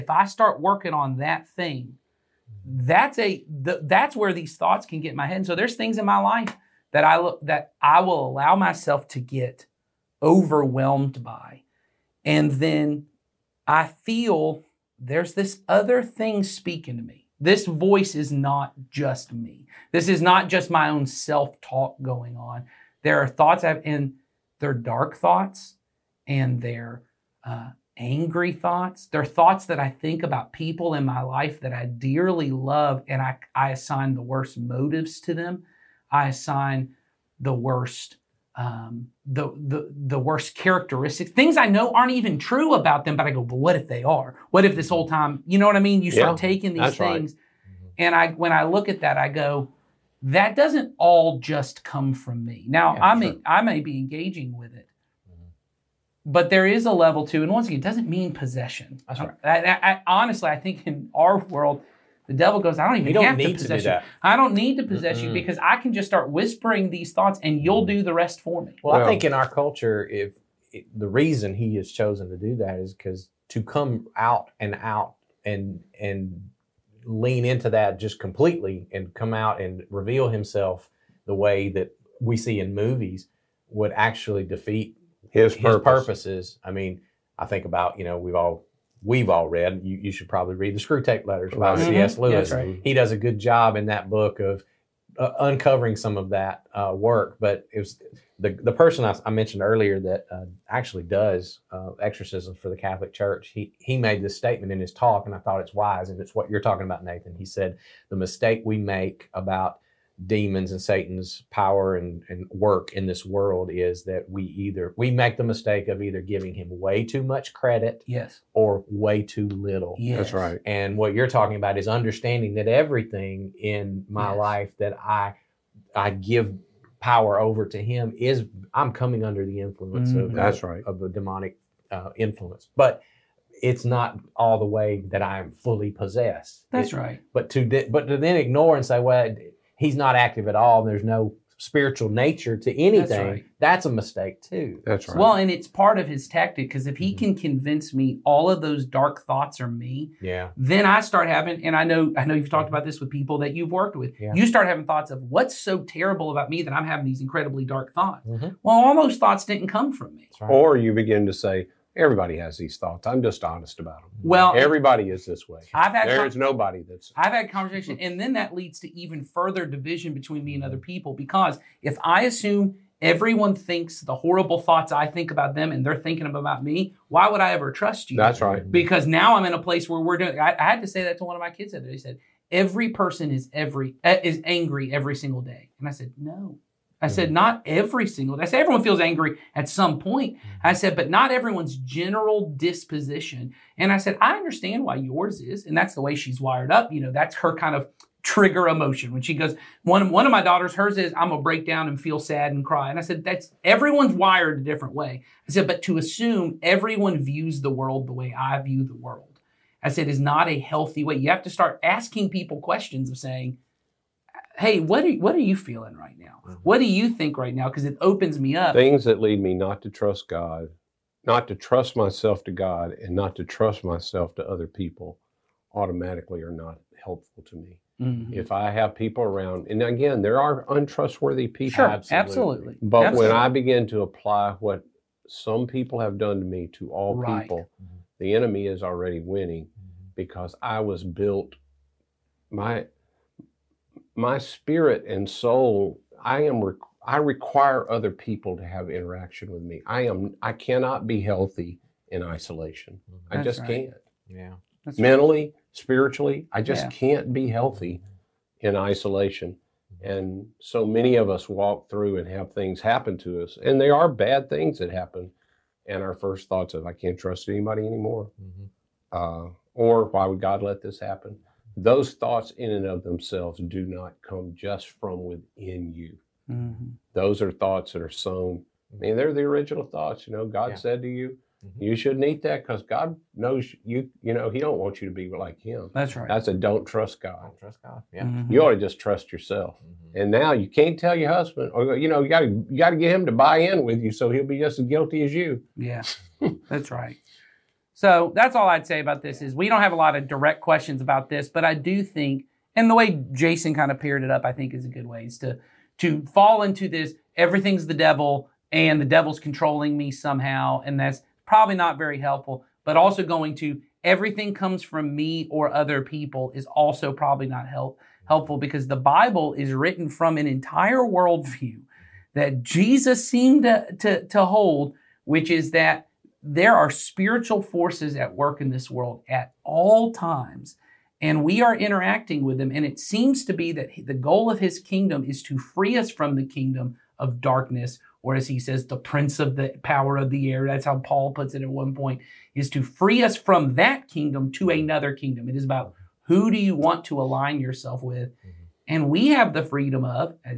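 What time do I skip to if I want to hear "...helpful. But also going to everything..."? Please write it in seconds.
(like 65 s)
312 s.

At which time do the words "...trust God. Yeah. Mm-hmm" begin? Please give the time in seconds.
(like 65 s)
287 s.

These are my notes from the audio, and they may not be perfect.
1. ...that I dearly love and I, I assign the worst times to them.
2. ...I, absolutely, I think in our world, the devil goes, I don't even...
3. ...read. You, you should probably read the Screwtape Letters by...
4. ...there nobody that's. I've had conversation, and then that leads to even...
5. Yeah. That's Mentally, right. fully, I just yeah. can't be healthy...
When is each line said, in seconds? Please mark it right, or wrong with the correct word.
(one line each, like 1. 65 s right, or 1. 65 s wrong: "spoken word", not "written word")
1. 31 s wrong: "motives", not "times"
2. 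59 s wrong: "honestly", not "absolutely"
3. 89 s right
4. 166 s right
5. 254 s wrong: "spiritually", not "fully".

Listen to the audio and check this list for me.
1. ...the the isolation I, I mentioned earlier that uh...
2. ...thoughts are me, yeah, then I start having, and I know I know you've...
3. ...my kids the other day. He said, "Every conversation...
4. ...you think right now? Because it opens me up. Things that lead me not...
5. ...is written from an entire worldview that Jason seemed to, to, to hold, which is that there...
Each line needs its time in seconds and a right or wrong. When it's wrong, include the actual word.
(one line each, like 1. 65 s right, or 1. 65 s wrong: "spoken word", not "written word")
1. 98 s wrong: "person", not "isolation"
2. 149 s right
3. 181 s wrong: "person", not "conversation"
4. 216 s right
5. 319 s wrong: "Jesus", not "Jason".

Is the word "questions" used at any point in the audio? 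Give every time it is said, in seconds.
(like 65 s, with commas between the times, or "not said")
212 s, 300 s.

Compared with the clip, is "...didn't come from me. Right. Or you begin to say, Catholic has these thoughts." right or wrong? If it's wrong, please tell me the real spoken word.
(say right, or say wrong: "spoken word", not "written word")
wrong: "Everybody", not "Catholic".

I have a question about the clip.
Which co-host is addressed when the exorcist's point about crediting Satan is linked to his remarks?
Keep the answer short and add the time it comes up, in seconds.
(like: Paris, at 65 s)
Nathan, at 107 s.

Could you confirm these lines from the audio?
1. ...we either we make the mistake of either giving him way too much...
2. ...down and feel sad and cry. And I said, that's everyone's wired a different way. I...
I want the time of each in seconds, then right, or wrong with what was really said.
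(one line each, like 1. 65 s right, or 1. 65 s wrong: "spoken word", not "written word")
1. 114 s right
2. 201 s right.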